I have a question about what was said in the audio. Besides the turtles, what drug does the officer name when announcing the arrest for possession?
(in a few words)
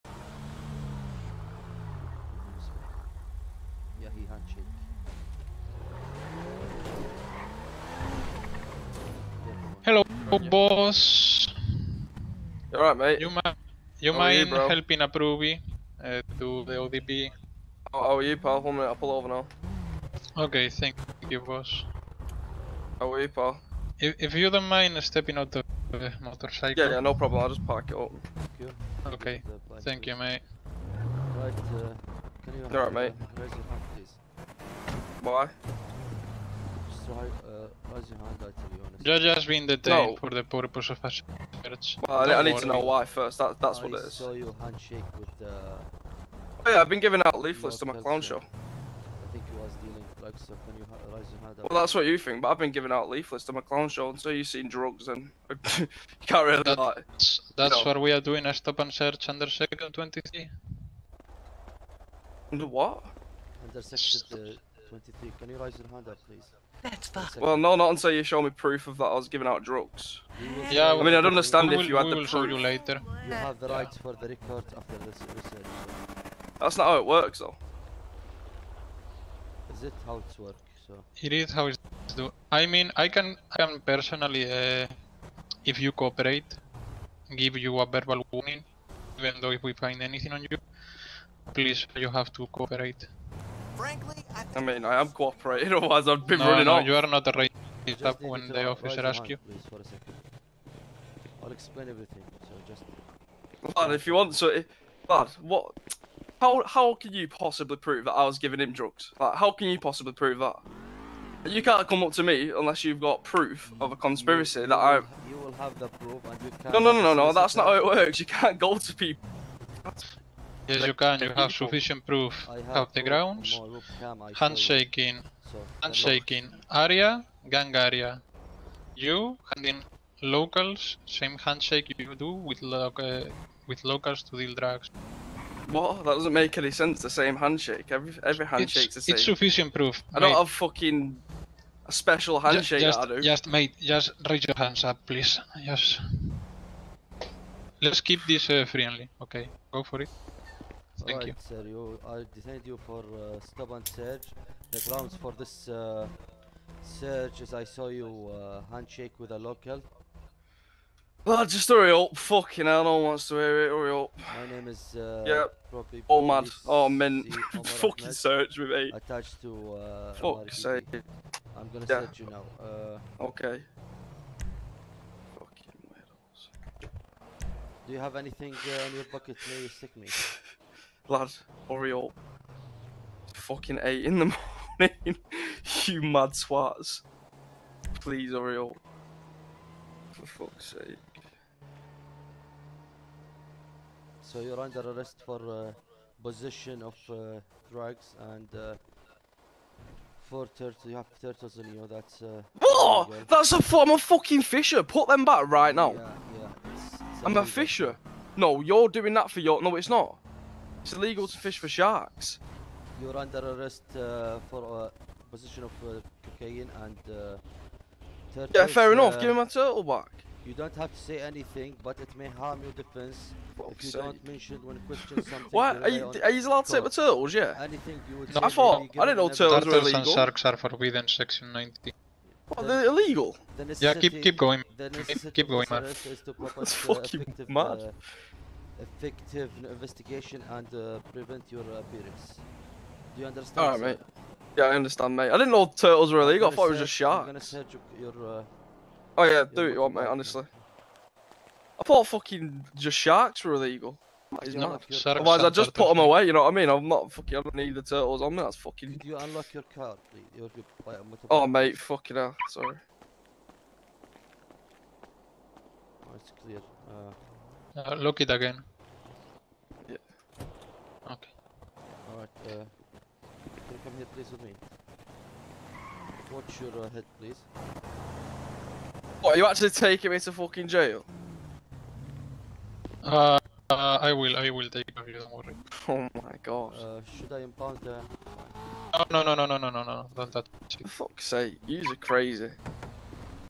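cocaine.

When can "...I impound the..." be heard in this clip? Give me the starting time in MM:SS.
04:47.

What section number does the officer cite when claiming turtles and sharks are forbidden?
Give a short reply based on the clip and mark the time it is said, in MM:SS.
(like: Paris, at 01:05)
90, at 03:51.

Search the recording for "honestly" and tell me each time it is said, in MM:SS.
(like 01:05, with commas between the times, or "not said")
00:38, 04:10.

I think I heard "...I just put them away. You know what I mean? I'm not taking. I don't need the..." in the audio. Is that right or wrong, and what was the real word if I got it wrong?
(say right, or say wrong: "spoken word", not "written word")
wrong: "fucking", not "taking".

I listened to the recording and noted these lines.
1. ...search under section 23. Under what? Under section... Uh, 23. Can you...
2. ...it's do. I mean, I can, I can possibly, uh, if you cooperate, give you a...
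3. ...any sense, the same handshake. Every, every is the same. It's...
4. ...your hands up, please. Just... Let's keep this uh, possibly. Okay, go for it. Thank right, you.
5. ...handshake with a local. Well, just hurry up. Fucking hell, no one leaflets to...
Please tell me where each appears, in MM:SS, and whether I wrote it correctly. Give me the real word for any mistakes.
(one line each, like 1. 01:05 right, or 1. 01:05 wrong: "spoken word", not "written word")
1. 00:58 right
2. 01:21 wrong: "personally", not "possibly"
3. 02:16 right
4. 02:24 wrong: "friendly", not "possibly"
5. 02:38 wrong: "wants", not "leaflets".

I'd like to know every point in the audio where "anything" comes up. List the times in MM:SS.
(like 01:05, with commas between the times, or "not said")
01:30, 02:58, 03:41, 03:47.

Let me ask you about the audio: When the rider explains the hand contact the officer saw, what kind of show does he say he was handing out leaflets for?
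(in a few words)
clown show.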